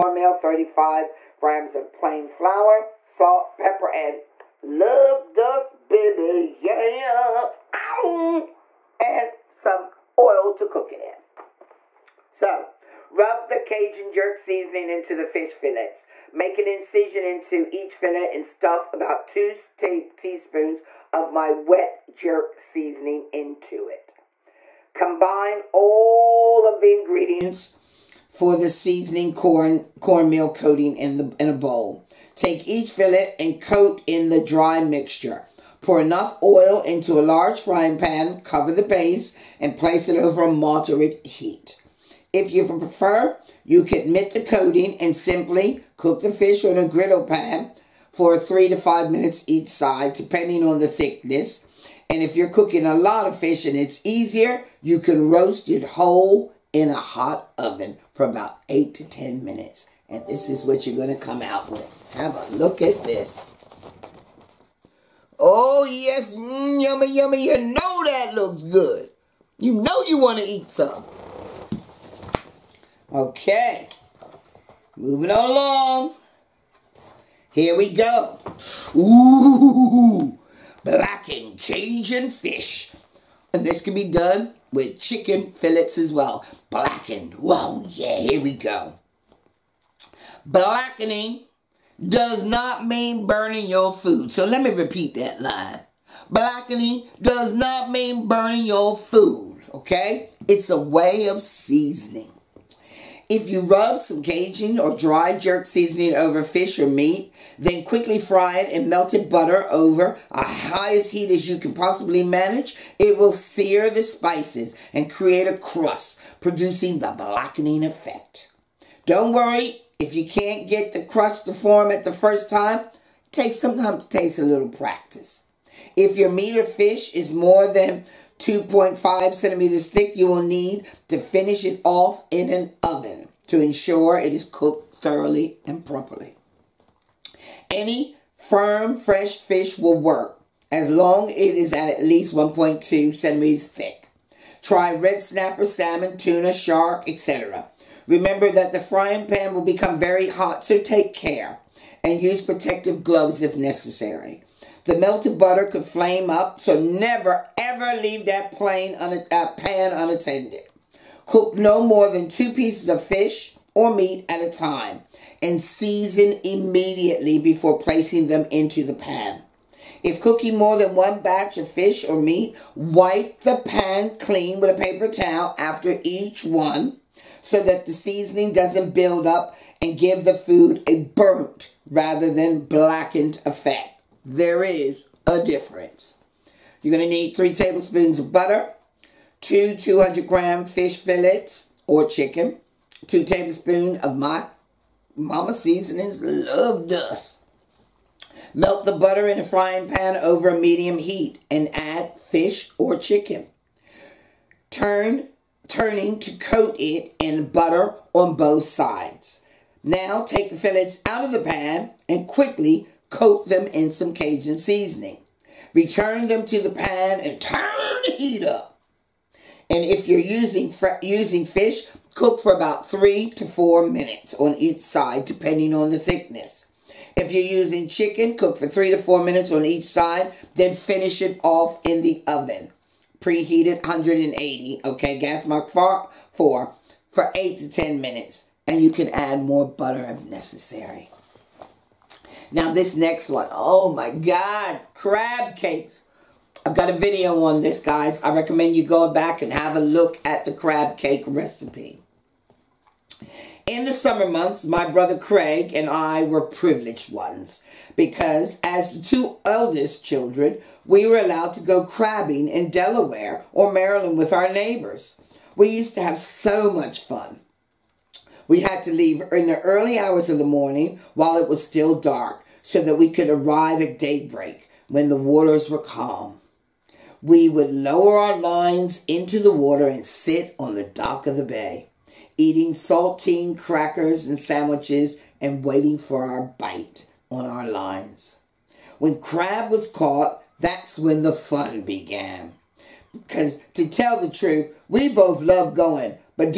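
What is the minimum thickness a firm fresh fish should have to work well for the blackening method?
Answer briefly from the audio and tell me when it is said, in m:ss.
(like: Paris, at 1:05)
1.2 centimeters, at 2:22.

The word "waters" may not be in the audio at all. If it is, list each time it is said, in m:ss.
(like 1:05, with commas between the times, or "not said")
4:35, 4:39.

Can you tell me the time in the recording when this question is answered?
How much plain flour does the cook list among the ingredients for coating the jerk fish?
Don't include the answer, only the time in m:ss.
0:00.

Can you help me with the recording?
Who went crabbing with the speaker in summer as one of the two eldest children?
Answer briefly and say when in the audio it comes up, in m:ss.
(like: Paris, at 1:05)
Craig, at 4:15.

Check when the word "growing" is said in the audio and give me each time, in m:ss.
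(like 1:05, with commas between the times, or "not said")
not said.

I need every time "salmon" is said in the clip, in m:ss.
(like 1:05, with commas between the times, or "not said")
2:25.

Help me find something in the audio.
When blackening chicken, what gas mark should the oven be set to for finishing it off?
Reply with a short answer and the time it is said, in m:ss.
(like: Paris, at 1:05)
gas mark 4, at 3:55.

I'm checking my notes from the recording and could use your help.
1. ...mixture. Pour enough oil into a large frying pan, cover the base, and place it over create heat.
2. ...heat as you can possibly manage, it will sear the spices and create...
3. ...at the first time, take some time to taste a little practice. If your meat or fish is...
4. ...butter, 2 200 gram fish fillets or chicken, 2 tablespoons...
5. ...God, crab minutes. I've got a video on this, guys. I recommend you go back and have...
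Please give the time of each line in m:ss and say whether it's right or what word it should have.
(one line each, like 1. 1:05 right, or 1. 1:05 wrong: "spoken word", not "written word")
1. 0:34 wrong: "moderate", not "create"
2. 1:51 right
3. 2:01 right
4. 3:08 right
5. 4:04 wrong: "cakes", not "minutes".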